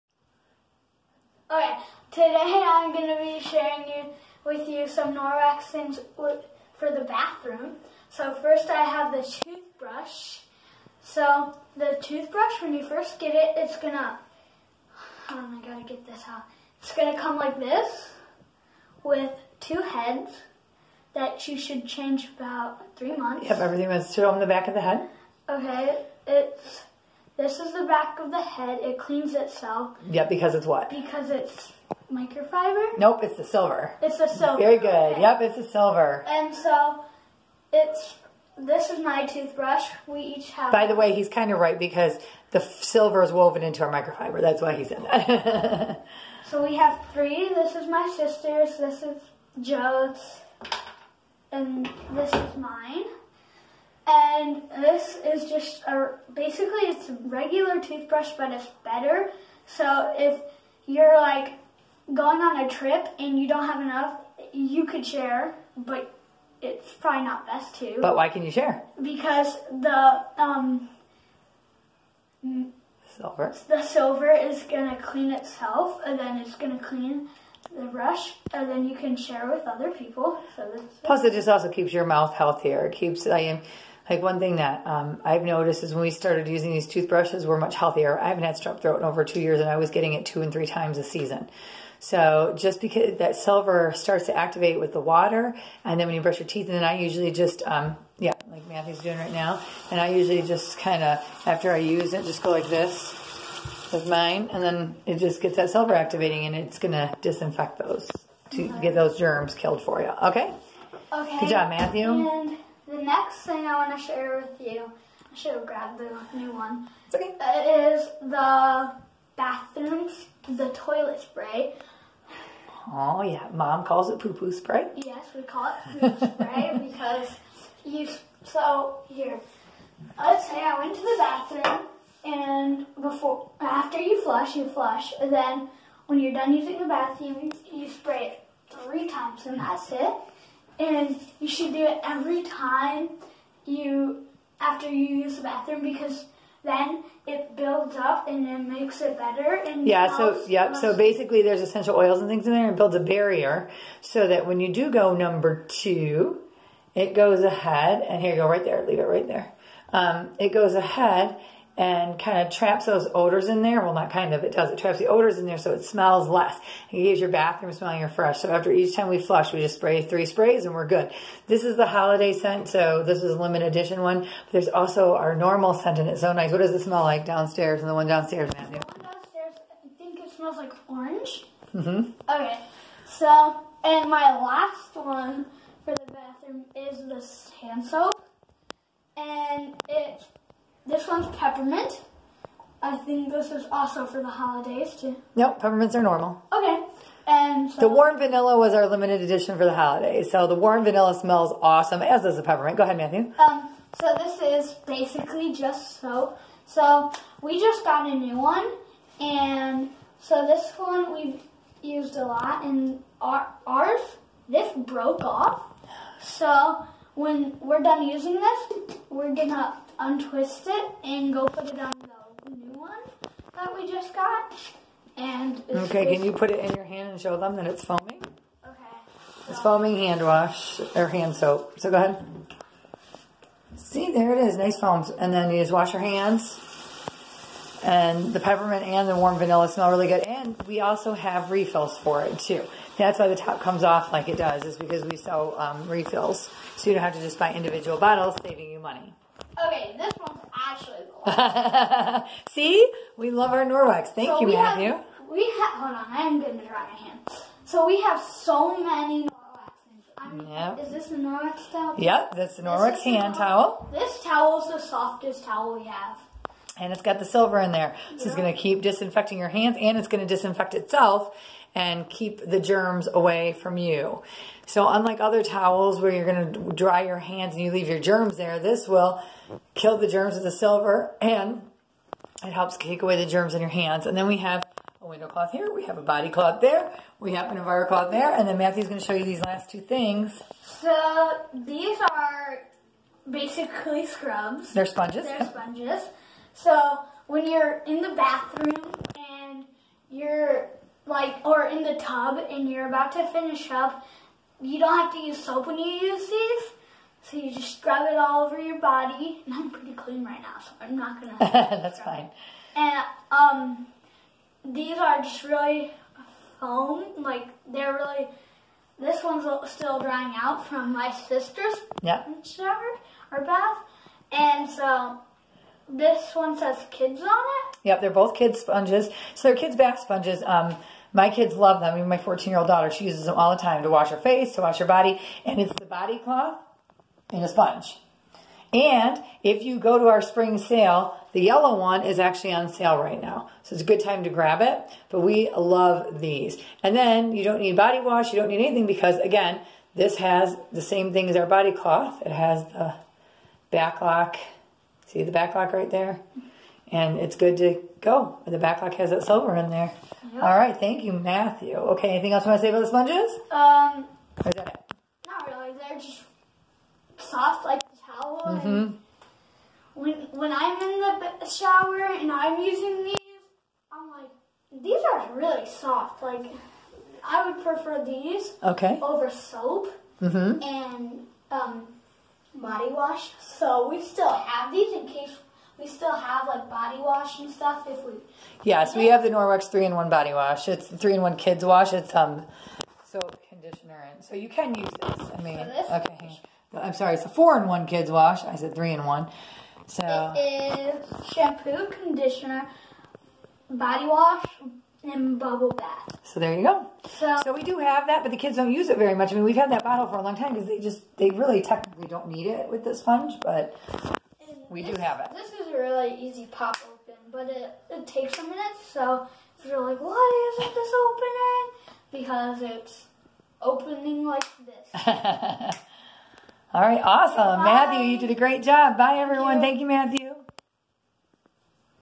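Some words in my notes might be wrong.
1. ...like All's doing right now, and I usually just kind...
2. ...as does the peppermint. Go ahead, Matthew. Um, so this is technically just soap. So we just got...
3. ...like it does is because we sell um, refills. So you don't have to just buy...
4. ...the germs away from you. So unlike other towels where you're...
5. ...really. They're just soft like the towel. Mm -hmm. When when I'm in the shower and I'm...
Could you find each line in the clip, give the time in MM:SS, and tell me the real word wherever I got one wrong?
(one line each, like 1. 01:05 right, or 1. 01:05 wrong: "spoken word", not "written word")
1. 01:38 wrong: "Matthew", not "All"
2. 03:22 wrong: "basically", not "technically"
3. 04:04 right
4. 04:32 right
5. 06:05 right.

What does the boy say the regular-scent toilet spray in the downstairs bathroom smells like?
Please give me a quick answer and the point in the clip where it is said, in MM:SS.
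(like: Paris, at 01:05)
Orange, at 03:00.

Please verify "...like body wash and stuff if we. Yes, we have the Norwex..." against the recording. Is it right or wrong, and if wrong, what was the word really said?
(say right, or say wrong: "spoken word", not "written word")
right.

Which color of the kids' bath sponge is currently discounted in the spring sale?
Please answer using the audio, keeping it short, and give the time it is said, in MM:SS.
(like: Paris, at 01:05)
Yellow, at 05:41.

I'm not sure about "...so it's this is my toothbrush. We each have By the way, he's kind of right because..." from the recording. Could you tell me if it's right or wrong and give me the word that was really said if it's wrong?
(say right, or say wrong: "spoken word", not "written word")
right.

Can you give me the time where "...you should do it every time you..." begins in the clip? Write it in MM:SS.
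02:21.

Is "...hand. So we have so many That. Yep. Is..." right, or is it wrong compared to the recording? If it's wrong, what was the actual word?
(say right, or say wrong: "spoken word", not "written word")
wrong: "Norwex", not "That".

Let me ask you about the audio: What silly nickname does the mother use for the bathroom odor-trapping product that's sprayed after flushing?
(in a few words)
Poo poo spray.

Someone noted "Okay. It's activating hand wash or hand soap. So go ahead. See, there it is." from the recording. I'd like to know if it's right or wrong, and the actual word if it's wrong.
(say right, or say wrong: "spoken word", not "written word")
wrong: "foaming", not "activating".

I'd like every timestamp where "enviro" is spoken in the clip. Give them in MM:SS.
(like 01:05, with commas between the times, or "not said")
04:47.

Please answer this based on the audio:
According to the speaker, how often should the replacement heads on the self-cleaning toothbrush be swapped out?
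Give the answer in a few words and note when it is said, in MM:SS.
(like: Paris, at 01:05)
About 3 months, at 00:22.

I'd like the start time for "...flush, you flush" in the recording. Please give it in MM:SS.
02:14.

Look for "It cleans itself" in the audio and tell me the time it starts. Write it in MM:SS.
00:28.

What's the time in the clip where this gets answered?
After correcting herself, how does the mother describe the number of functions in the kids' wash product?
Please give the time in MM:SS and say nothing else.
06:37.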